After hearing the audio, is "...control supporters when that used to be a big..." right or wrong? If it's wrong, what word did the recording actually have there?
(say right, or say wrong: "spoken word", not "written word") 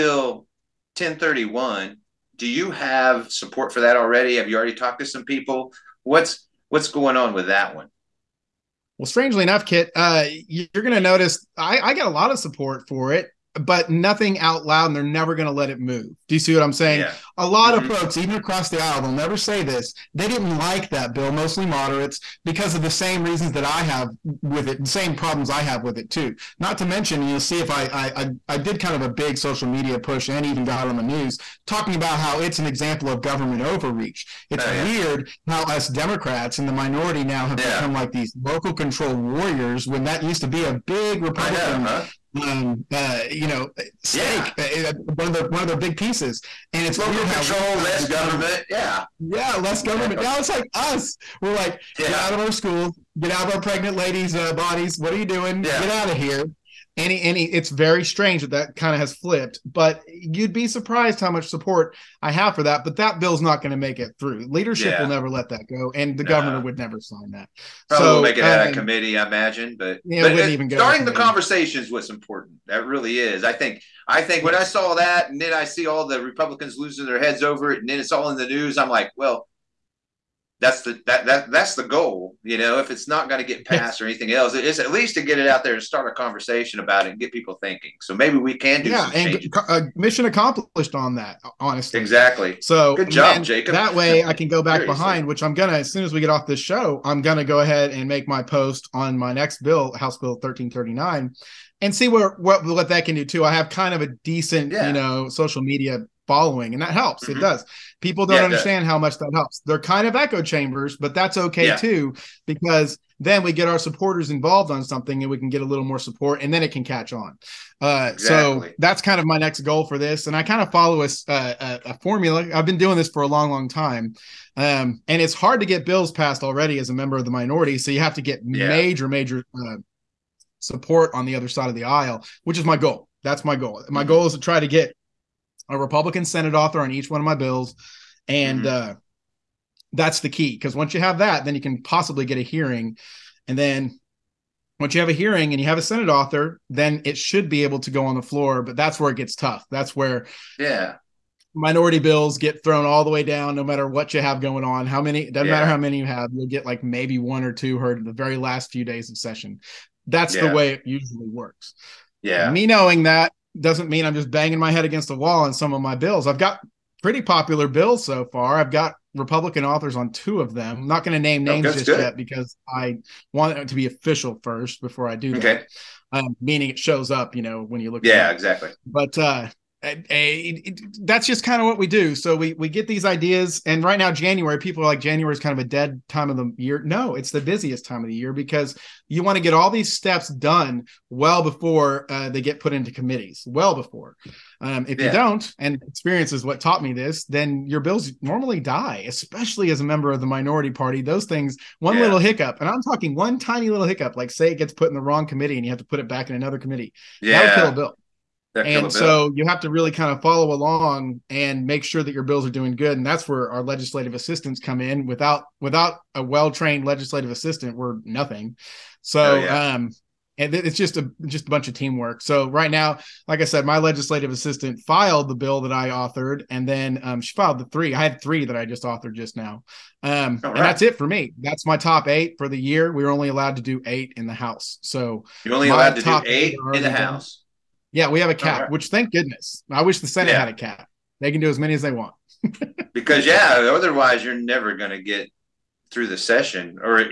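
wrong: "warriors", not "supporters".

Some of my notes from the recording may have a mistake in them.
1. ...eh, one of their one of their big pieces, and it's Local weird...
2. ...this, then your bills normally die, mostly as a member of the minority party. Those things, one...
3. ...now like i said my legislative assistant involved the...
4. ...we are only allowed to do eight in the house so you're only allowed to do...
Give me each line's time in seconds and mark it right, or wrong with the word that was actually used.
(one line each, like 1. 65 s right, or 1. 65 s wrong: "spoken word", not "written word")
1. 44 s right
2. 196 s wrong: "especially", not "mostly"
3. 222 s wrong: "filed", not "involved"
4. 232 s right.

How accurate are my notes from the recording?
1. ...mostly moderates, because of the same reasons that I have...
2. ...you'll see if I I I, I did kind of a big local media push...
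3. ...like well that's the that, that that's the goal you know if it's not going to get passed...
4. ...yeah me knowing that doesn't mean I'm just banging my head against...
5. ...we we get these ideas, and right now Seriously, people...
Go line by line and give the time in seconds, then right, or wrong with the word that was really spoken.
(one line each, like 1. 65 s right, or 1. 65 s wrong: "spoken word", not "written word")
1. 21 s right
2. 27 s wrong: "social", not "local"
3. 78 s right
4. 162 s right
5. 182 s wrong: "January", not "Seriously".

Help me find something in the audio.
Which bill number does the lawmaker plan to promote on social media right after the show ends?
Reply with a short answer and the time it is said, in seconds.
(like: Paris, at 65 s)
House Bill 1339, at 99 s.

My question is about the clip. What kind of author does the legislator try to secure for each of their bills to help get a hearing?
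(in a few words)
Republican Senate author.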